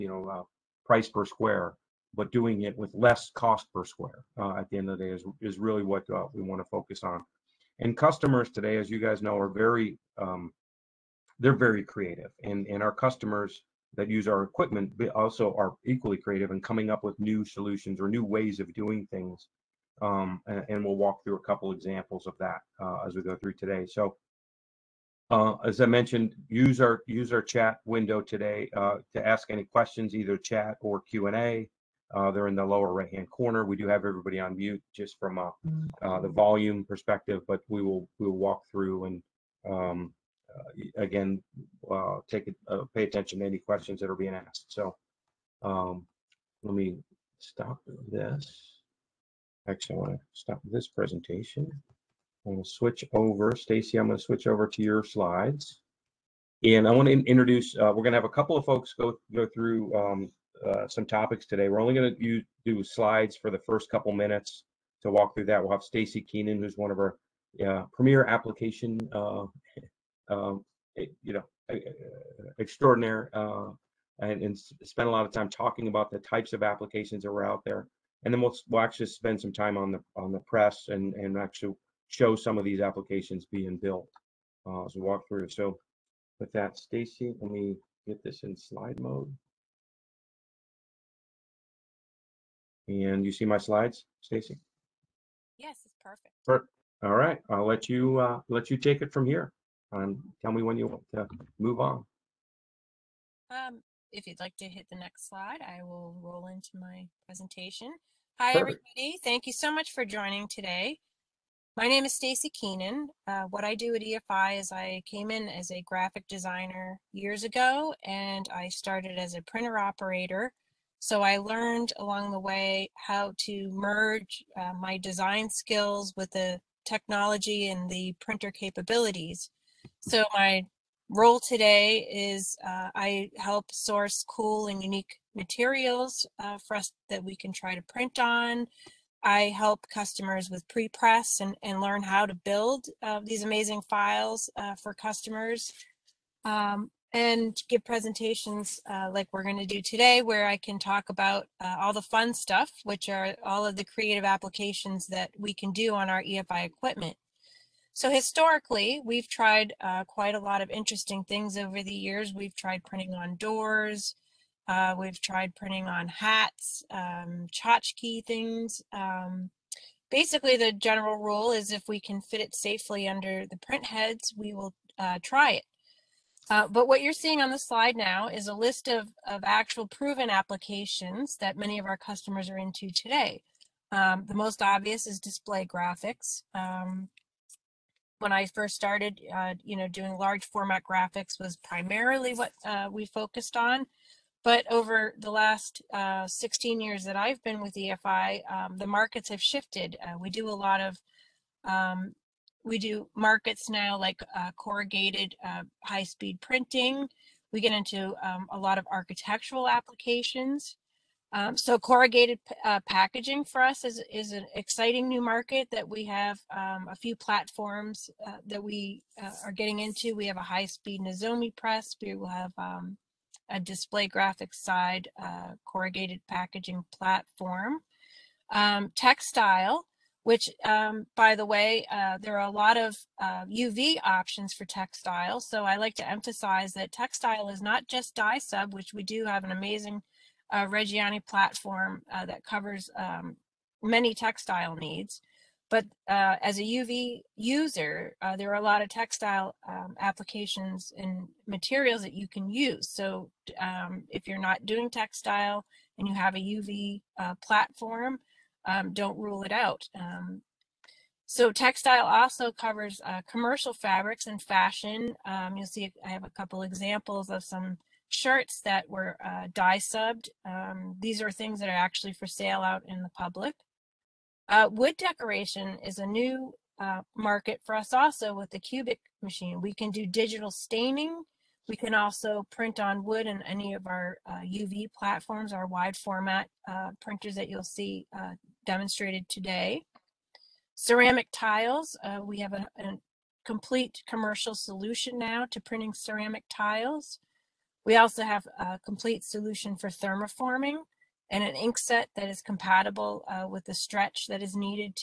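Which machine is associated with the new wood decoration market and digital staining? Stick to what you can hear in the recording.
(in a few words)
Cubik.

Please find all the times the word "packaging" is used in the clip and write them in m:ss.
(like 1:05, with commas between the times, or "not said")
3:32, 3:46.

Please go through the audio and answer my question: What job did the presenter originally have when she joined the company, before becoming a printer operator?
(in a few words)
graphic designer.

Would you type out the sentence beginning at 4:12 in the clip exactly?
So um, if you're not doing textile and you have a UV uh, platform, um, don't rule it out.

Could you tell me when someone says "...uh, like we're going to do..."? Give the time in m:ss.
2:28.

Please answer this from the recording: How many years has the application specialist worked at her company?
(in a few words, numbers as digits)
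16.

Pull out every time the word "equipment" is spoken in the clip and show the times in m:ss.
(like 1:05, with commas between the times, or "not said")
0:14, 2:36.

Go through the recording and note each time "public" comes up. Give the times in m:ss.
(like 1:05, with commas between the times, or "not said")
4:33.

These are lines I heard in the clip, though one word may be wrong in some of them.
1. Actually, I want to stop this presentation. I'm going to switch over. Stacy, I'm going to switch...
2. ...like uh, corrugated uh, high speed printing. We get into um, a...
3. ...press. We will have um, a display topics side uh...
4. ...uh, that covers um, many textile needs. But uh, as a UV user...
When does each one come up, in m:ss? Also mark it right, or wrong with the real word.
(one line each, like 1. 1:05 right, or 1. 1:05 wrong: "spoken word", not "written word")
1. 0:49 right
2. 3:23 right
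3. 3:41 wrong: "graphics", not "topics"
4. 4:02 right.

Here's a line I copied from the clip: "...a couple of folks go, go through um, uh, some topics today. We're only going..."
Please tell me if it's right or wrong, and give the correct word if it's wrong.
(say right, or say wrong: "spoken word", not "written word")
right.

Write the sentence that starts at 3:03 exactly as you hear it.
Um, the most obvious is display graphics.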